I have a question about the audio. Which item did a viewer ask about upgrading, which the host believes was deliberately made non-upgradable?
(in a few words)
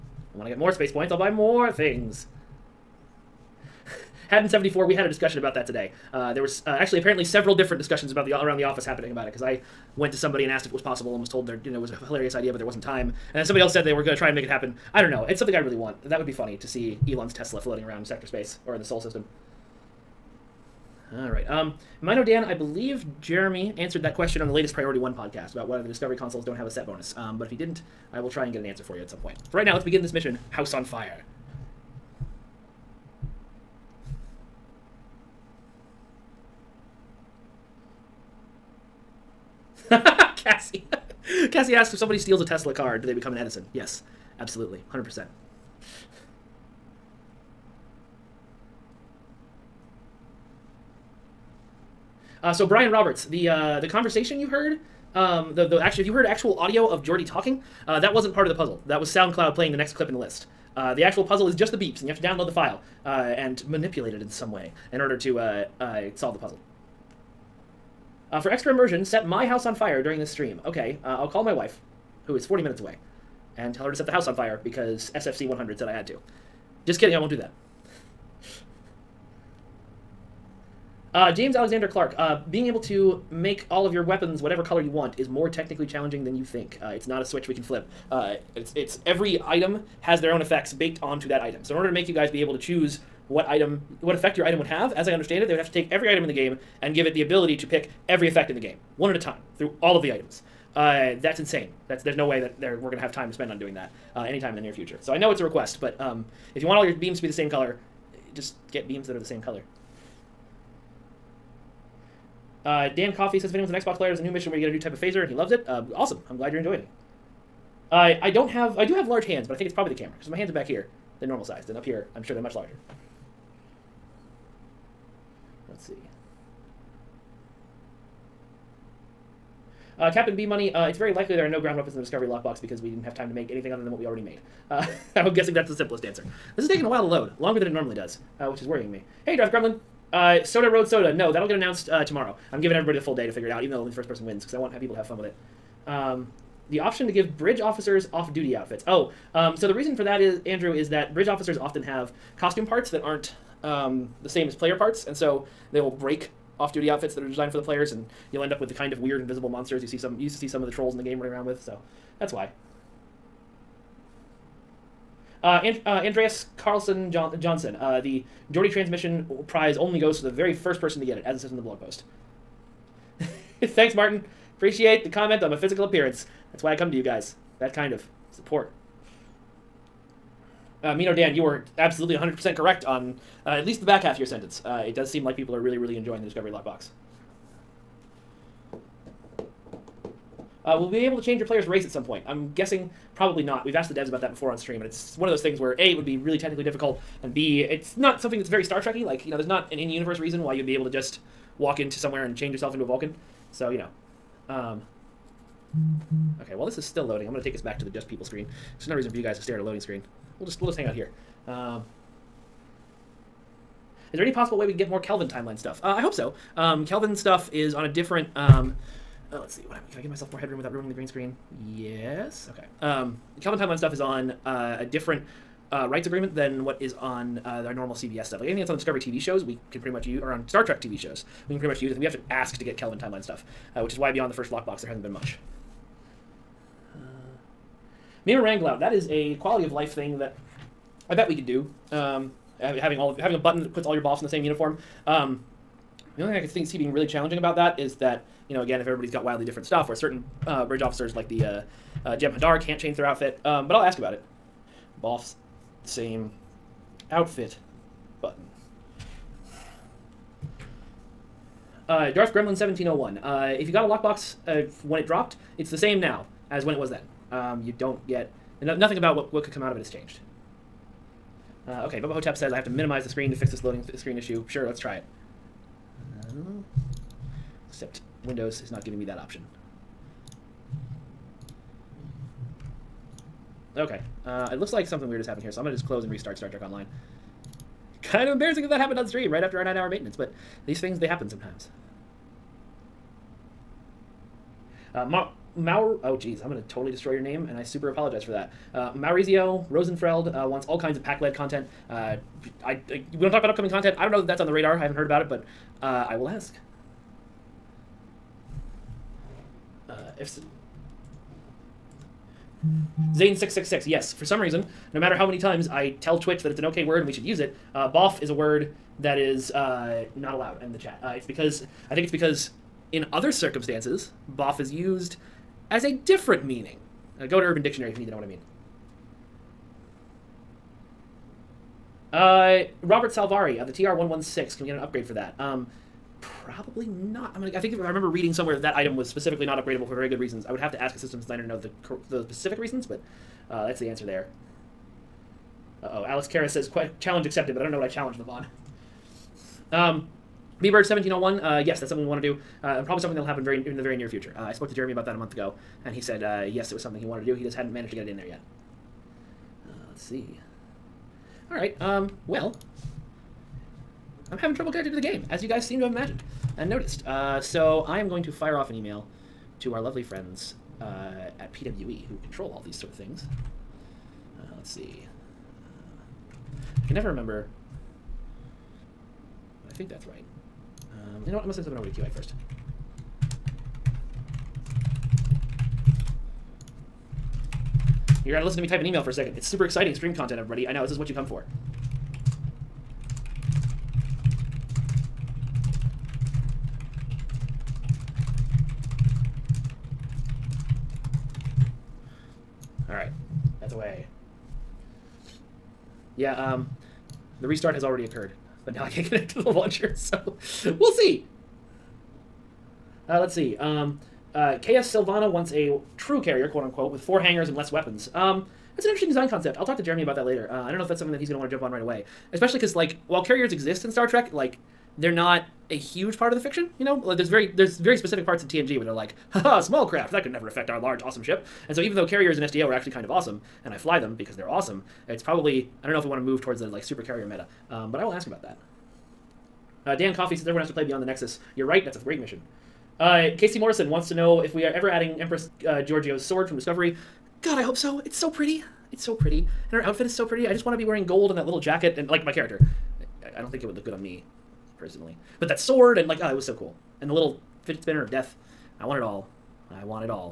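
TR116.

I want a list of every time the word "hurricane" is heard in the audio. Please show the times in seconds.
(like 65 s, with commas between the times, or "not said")
not said.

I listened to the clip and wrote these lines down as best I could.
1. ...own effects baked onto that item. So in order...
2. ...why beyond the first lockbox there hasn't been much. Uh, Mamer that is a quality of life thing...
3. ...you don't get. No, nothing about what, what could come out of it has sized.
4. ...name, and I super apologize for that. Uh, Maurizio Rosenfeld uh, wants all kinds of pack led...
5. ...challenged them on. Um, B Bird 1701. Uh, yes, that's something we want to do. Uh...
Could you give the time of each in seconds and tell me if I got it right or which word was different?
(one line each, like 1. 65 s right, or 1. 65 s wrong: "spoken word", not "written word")
1. 90 s right
2. 233 s right
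3. 267 s wrong: "changed", not "sized"
4. 297 s right
5. 347 s right.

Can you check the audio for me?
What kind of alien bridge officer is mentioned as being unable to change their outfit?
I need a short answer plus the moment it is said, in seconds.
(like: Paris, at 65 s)
Jem Hadar, at 252 s.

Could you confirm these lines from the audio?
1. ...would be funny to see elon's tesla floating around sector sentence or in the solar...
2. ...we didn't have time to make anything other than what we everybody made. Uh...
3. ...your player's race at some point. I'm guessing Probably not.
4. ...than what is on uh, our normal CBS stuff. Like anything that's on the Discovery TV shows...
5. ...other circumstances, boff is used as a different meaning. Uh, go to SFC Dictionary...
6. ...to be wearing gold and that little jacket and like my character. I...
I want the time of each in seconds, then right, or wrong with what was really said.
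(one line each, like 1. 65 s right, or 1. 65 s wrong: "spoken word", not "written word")
1. 16 s wrong: "space", not "sentence"
2. 132 s wrong: "already", not "everybody"
3. 191 s right
4. 226 s right
5. 323 s wrong: "Urban", not "SFC"
6. 450 s right.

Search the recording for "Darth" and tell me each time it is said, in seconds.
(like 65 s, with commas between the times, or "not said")
139 s, 262 s.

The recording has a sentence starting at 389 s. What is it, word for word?
It's super exciting stream content, everybody.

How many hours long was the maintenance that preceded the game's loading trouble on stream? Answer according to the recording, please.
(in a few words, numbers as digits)
9.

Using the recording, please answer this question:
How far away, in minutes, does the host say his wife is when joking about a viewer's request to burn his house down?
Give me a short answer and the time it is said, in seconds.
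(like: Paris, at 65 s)
40, at 72 s.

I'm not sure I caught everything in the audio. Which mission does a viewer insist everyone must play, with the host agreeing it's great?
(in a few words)
Beyond the Nexus.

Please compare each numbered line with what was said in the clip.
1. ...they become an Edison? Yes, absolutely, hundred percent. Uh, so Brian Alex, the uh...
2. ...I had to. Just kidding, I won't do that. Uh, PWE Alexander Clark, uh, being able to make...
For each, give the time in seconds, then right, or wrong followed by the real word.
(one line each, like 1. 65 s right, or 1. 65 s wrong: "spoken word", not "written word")
1. 43 s wrong: "Roberts", not "Alex"
2. 75 s wrong: "James", not "PWE".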